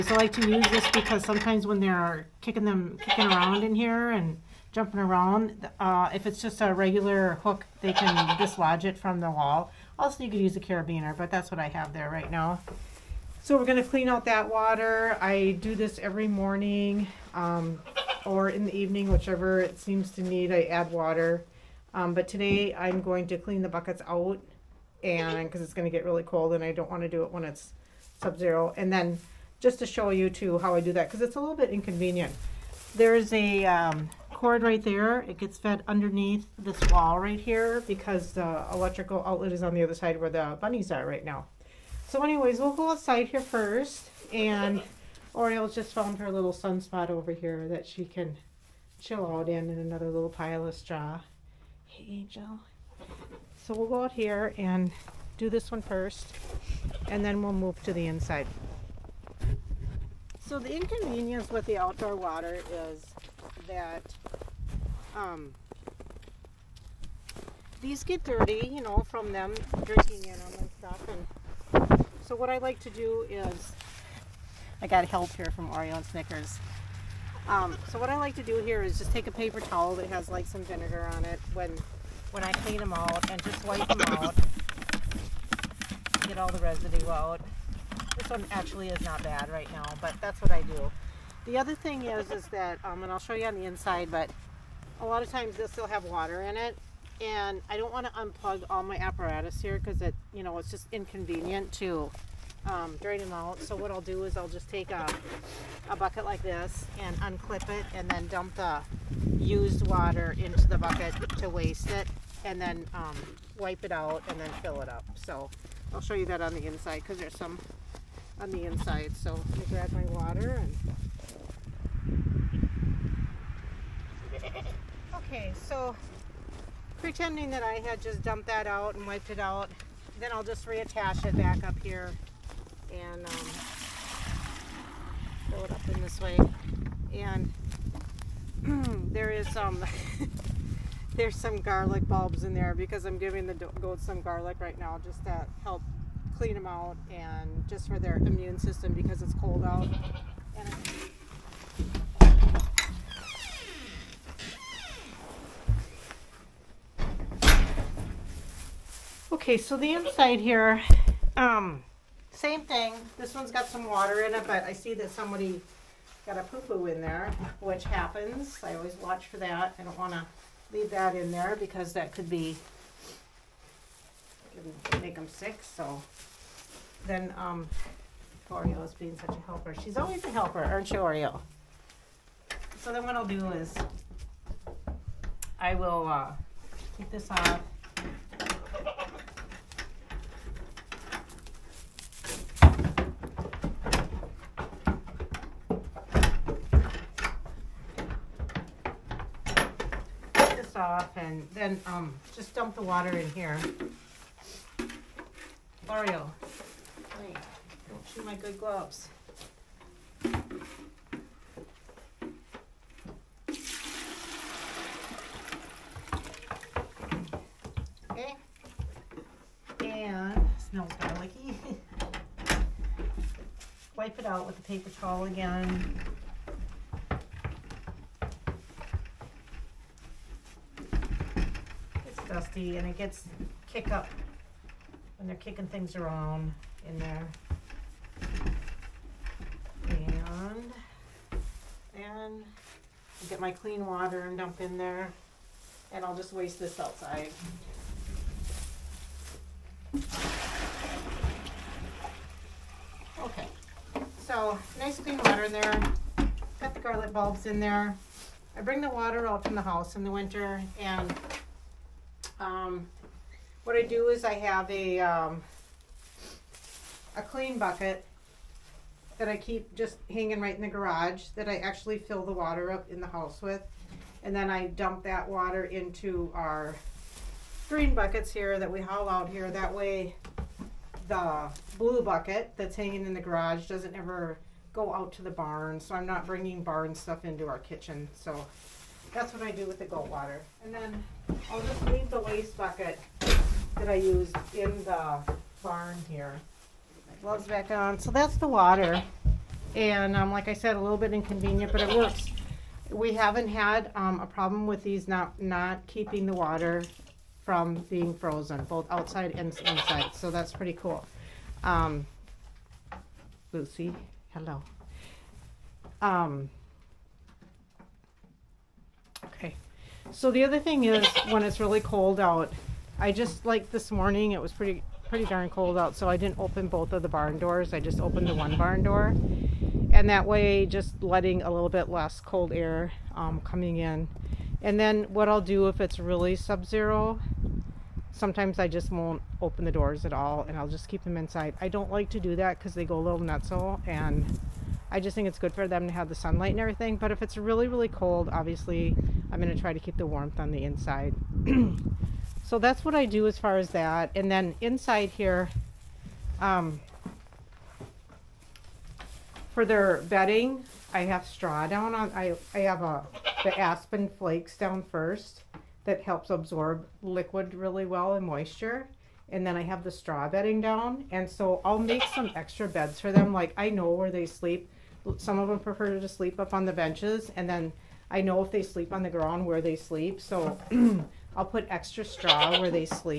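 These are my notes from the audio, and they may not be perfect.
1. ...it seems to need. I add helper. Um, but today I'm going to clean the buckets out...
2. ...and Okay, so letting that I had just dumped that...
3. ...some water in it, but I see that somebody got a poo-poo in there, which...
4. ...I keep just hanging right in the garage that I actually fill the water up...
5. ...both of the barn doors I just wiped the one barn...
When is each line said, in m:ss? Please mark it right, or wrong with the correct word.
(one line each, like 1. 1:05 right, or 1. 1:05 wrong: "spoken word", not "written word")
1. 0:19 wrong: "water", not "helper"
2. 2:00 wrong: "pretending", not "letting"
3. 2:43 right
4. 4:29 right
5. 5:26 wrong: "opened", not "wiped".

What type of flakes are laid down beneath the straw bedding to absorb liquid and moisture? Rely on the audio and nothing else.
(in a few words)
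aspen flakes.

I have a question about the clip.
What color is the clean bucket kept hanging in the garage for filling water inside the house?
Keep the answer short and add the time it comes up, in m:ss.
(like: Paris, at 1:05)
blue, at 4:41.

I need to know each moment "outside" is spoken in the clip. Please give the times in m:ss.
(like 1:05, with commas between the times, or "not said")
0:42, 4:06, 5:08.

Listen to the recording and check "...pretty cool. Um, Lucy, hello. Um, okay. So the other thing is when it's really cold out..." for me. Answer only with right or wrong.
right.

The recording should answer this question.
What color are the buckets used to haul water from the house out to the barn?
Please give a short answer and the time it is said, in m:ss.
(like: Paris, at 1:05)
green, at 4:37.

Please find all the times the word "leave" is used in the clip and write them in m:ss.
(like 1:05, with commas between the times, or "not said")
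2:50, 4:51.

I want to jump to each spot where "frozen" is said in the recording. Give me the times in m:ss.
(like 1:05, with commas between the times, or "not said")
5:08.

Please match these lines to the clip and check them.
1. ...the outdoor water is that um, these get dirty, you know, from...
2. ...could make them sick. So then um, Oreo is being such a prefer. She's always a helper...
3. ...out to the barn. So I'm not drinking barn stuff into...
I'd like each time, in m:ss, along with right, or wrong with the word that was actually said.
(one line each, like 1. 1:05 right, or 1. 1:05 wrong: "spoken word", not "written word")
1. 1:01 right
2. 2:54 wrong: "helper", not "prefer"
3. 4:44 wrong: "bringing", not "drinking".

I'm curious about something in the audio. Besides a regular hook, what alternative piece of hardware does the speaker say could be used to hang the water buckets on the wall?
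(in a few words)
carabiner.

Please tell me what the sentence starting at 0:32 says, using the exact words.
There's a um, cord right there.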